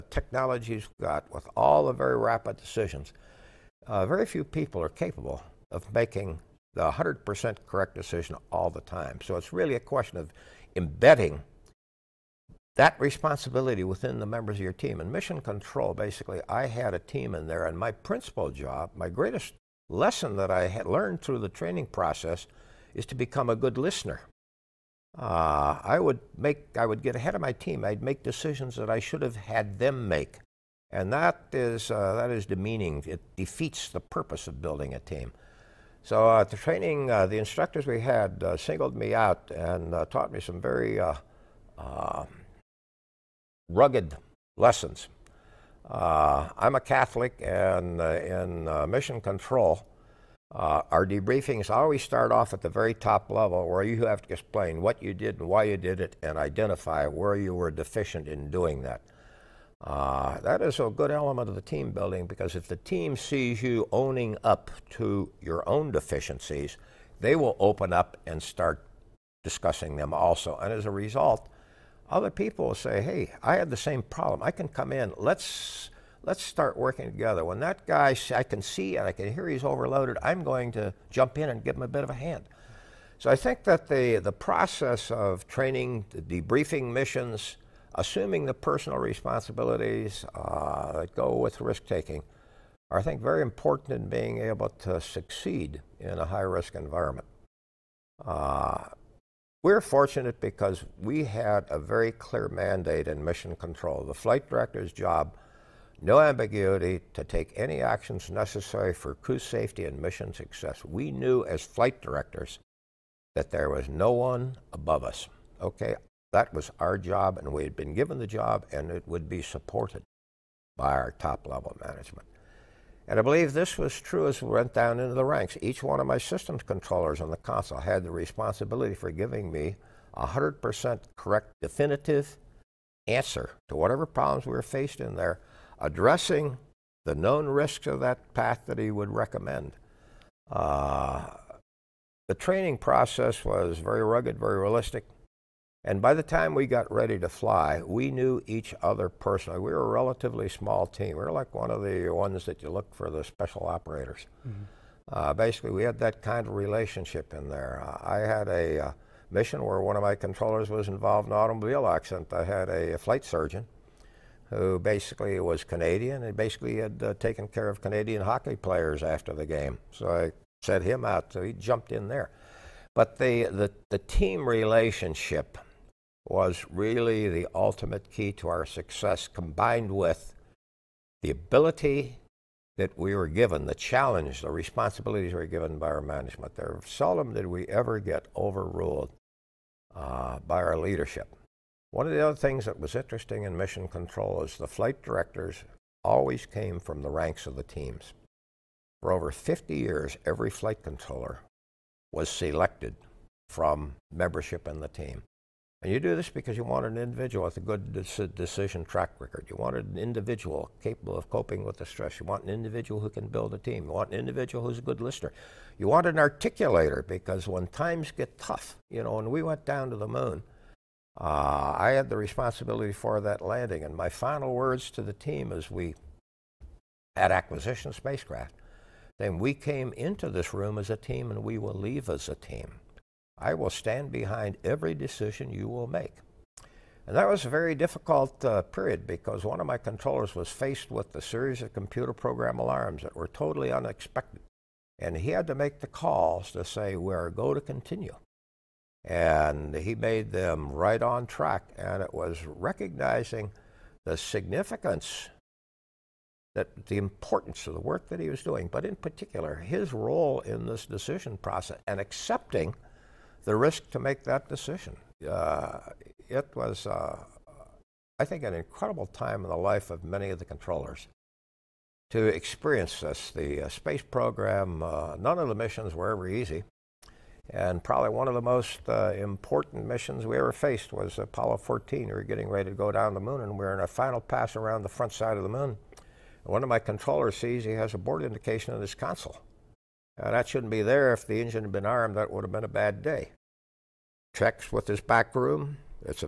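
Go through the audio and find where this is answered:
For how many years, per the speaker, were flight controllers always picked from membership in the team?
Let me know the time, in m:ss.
3:19.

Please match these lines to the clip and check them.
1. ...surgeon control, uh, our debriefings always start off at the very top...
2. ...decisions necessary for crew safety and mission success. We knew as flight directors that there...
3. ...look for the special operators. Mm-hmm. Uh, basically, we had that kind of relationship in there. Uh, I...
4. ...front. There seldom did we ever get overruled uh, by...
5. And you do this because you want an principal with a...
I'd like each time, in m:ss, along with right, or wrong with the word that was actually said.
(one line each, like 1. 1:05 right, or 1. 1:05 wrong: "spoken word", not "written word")
1. 0:48 wrong: "mission", not "surgeon"
2. 1:47 wrong: "actions", not "decisions"
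3. 2:32 right
4. 3:06 wrong: "management", not "front"
5. 3:25 wrong: "individual", not "principal".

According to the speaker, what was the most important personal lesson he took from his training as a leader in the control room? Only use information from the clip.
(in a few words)
Become a good listener.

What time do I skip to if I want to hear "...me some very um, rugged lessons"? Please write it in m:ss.
0:40.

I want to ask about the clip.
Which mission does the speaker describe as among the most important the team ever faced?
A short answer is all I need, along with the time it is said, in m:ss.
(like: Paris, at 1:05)
Apollo 14, at 4:41.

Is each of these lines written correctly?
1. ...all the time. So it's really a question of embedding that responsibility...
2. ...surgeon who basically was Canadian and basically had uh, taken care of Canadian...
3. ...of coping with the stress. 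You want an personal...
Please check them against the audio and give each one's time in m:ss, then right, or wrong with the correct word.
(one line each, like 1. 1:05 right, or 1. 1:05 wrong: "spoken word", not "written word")
1. 0:08 right
2. 2:43 right
3. 3:31 wrong: "individual", not "personal".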